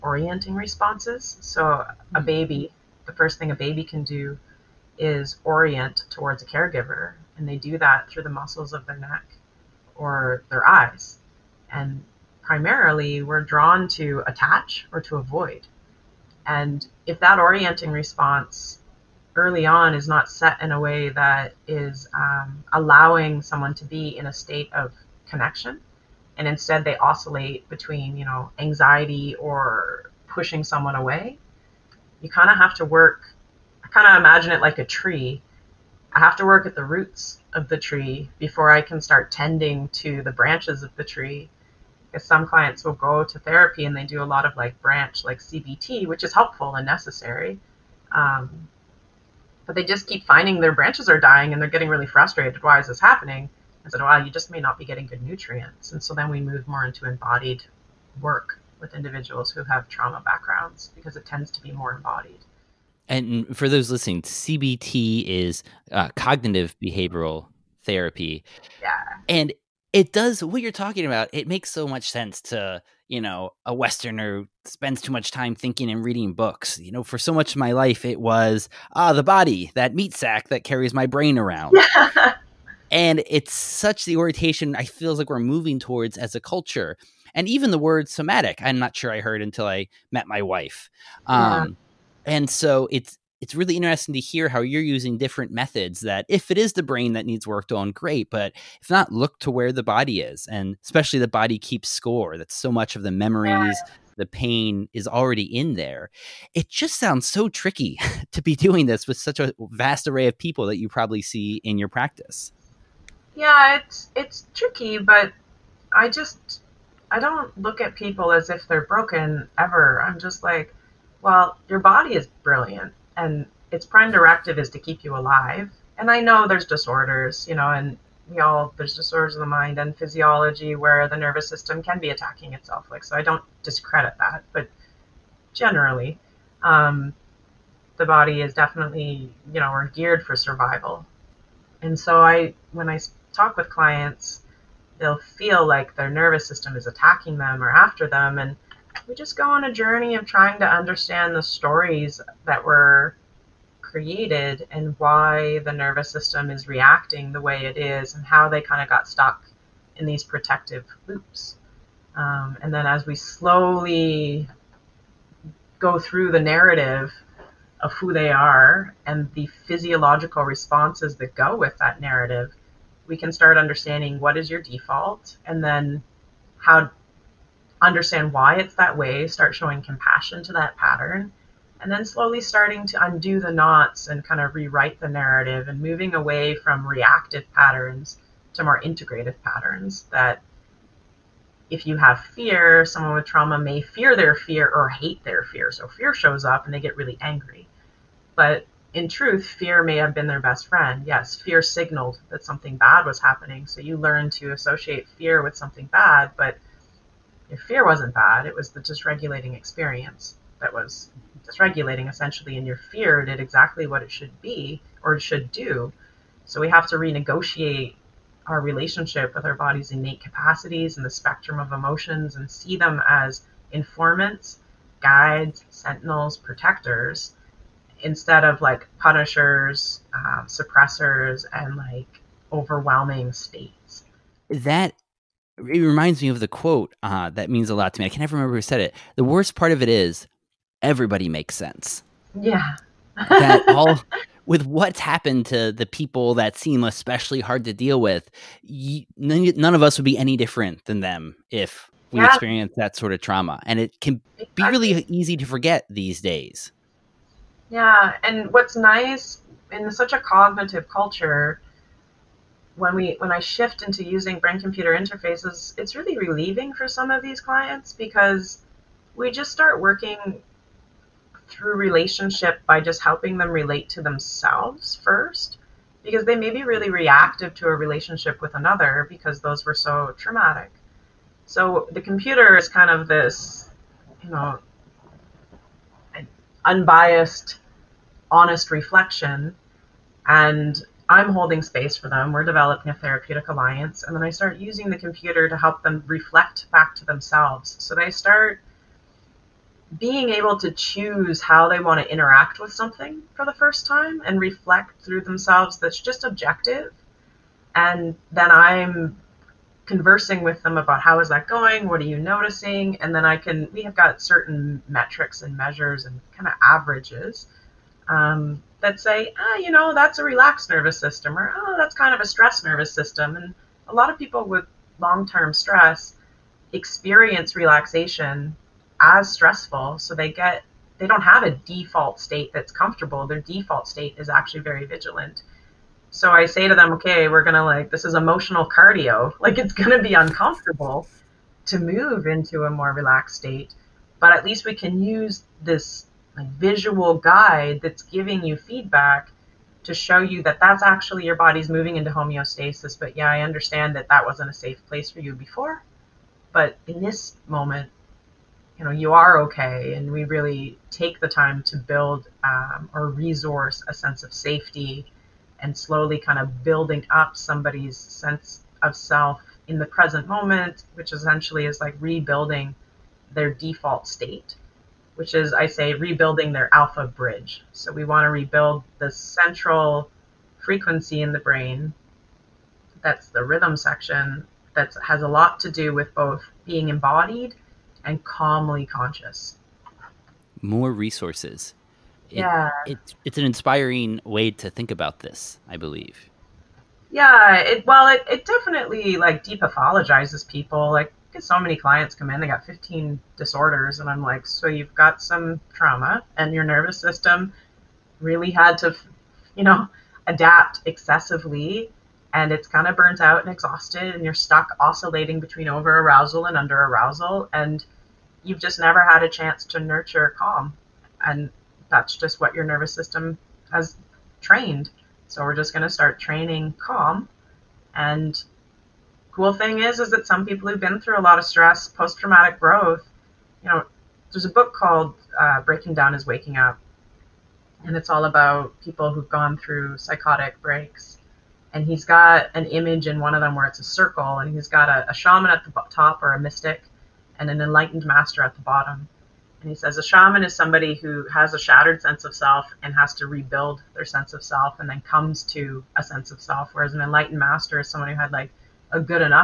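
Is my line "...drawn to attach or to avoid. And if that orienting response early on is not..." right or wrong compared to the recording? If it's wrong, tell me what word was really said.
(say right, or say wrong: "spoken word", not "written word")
right.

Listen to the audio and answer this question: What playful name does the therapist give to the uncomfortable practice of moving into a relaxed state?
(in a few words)
Emotional cardio.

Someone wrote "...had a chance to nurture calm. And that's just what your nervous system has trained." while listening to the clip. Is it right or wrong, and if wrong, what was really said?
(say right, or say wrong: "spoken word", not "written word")
right.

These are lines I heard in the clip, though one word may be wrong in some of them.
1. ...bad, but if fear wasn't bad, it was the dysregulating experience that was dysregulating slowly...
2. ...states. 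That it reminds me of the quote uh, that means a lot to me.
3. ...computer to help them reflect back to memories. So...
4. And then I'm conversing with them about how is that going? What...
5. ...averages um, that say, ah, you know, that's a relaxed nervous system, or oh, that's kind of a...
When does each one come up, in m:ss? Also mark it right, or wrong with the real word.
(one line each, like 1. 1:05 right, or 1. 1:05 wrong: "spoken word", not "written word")
1. 3:25 wrong: "essentially", not "slowly"
2. 3:53 right
3. 4:54 wrong: "themselves", not "memories"
4. 5:07 right
5. 5:16 right.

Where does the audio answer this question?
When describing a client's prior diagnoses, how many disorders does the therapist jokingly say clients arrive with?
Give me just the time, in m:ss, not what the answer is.
6:42.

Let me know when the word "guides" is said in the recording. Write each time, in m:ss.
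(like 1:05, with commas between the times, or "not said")
3:44, 5:47.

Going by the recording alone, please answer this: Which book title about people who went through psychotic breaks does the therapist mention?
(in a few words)
Breaking Down Is Waking Up.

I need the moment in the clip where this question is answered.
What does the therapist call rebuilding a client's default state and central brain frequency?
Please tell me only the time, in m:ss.
6:16.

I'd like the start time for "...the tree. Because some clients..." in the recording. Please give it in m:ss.
0:40.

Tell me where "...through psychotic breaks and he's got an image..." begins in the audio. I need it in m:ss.
7:19.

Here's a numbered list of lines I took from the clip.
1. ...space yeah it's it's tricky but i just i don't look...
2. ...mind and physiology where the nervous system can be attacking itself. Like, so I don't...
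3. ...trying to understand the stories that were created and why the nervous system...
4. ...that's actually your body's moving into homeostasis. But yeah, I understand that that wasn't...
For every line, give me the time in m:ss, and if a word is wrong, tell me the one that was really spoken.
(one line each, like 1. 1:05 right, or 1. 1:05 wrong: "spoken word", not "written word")
1. 1:51 wrong: "practice", not "space"
2. 2:09 right
3. 2:30 right
4. 5:50 right.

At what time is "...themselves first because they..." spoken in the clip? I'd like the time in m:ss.
4:34.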